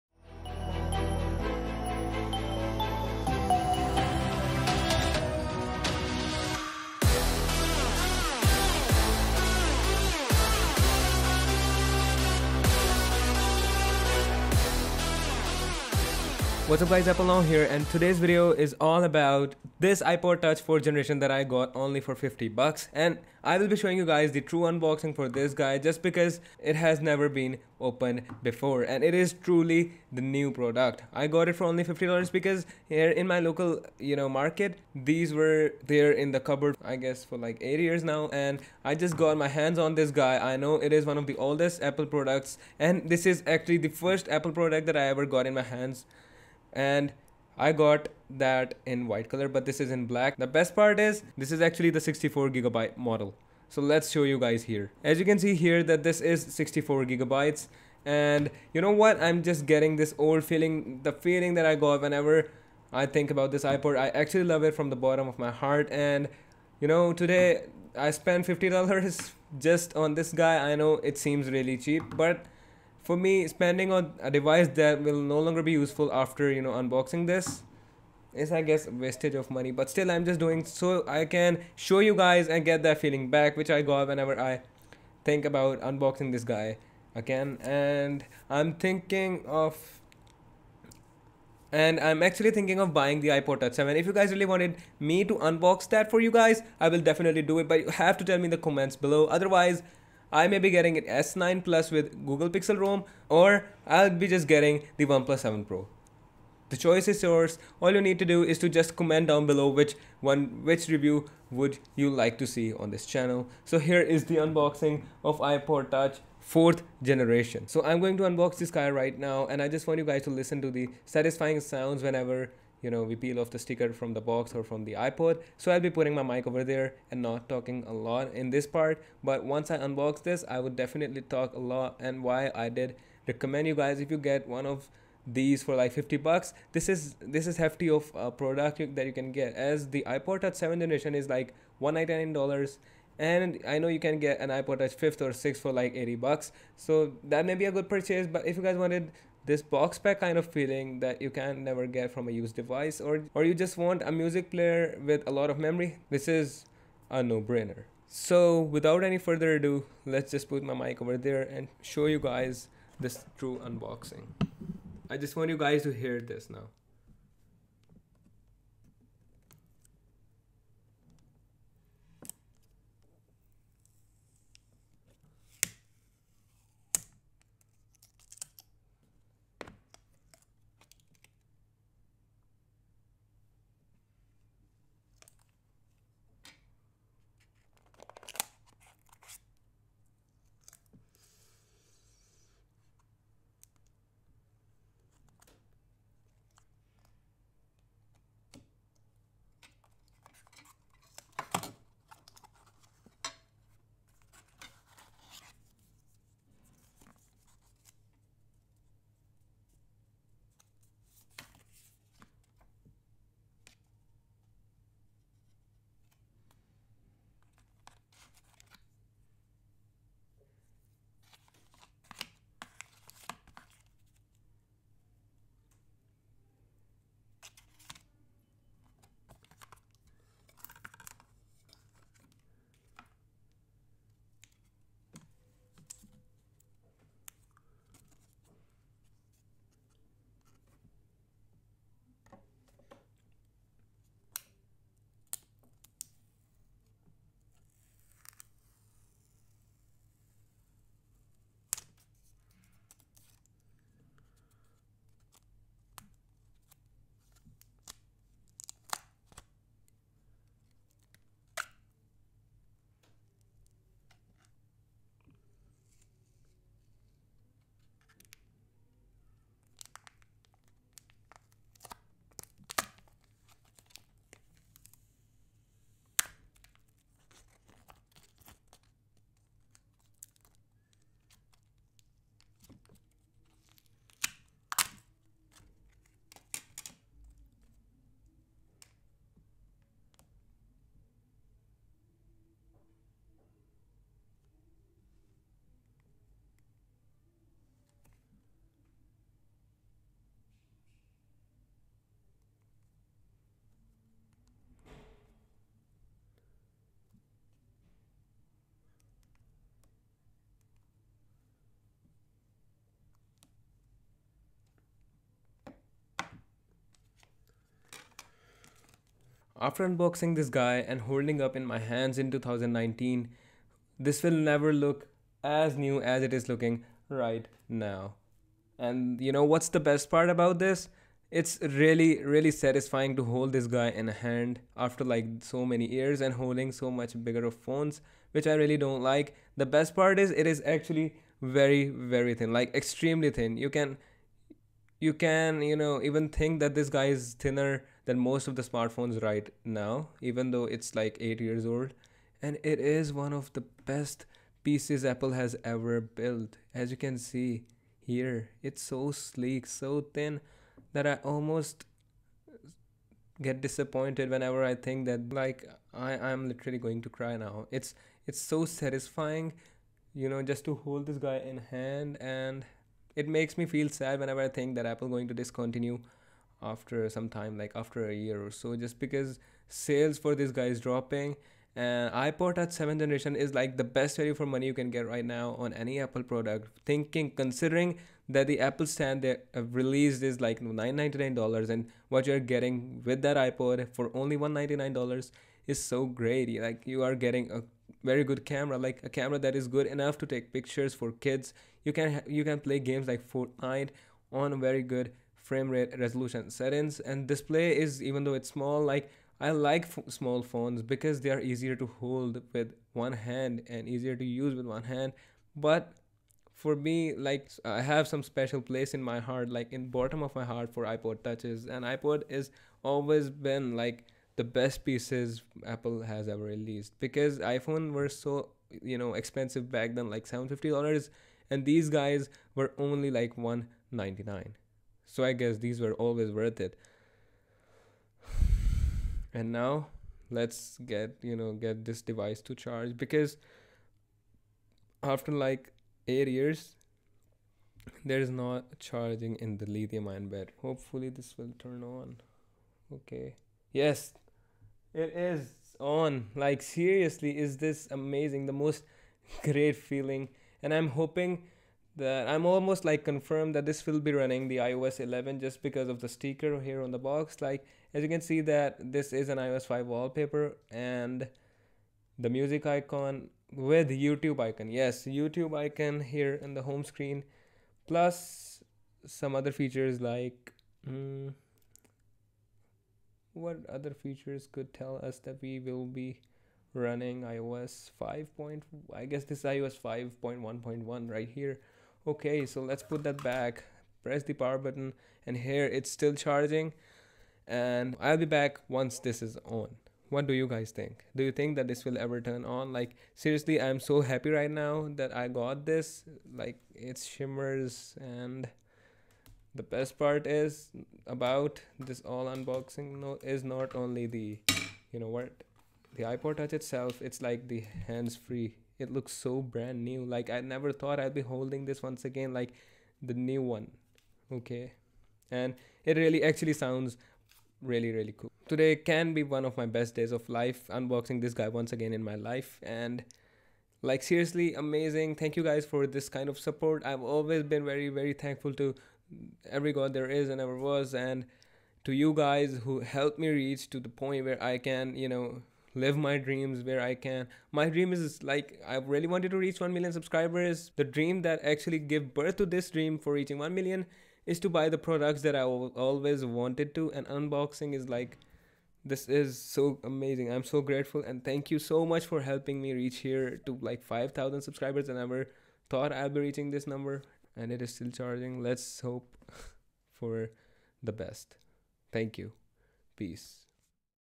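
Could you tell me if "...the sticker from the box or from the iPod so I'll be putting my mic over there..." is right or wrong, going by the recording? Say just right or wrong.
right.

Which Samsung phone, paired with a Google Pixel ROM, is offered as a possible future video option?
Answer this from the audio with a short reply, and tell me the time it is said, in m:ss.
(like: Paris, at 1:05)
S9 Plus, at 1:41.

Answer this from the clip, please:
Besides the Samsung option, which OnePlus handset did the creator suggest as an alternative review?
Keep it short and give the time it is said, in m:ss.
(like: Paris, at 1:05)
OnePlus 7 Pro, at 1:45.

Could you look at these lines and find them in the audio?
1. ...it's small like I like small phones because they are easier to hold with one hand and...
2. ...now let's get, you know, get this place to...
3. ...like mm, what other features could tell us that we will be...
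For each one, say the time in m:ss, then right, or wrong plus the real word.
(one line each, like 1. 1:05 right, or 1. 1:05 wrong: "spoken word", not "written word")
1. 6:48 right
2. 7:19 wrong: "device", not "place"
3. 8:00 right.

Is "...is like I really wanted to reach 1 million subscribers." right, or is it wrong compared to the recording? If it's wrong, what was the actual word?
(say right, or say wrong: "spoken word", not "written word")
right.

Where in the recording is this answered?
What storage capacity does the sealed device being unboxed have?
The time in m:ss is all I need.
0:51.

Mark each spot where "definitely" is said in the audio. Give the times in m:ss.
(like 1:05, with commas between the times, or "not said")
1:37, 2:10.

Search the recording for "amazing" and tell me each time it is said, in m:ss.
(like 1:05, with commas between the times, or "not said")
7:37, 8:54, 9:19.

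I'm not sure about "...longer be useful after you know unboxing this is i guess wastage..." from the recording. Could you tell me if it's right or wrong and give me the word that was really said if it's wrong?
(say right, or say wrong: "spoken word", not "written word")
right.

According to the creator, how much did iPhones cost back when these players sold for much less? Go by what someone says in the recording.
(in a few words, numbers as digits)
$750.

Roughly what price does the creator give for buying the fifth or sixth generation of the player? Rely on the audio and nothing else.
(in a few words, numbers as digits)
$80.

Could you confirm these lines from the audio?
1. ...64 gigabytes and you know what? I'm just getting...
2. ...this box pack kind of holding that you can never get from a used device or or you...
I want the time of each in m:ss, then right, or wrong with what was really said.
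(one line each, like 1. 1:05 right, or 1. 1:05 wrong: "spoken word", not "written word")
1. 0:56 right
2. 2:29 wrong: "feeling", not "holding".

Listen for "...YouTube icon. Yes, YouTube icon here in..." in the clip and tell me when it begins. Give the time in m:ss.
7:53.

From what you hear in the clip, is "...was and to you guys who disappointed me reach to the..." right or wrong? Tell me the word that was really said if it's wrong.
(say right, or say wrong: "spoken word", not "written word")
wrong: "helped", not "disappointed".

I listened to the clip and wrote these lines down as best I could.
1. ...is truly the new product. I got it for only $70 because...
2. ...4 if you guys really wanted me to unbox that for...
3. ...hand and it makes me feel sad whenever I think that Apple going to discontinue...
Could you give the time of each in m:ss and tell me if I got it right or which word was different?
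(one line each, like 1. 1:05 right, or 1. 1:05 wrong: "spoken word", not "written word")
1. 0:29 wrong: "50", not "70"
2. 1:33 wrong: "7", not "4"
3. 6:11 right.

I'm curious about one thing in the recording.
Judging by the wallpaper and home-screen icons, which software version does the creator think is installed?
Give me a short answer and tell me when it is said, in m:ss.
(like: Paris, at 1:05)
iOS 5.1.1, at 8:09.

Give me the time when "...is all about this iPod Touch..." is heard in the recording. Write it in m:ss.
0:18.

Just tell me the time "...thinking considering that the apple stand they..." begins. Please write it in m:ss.
6:26.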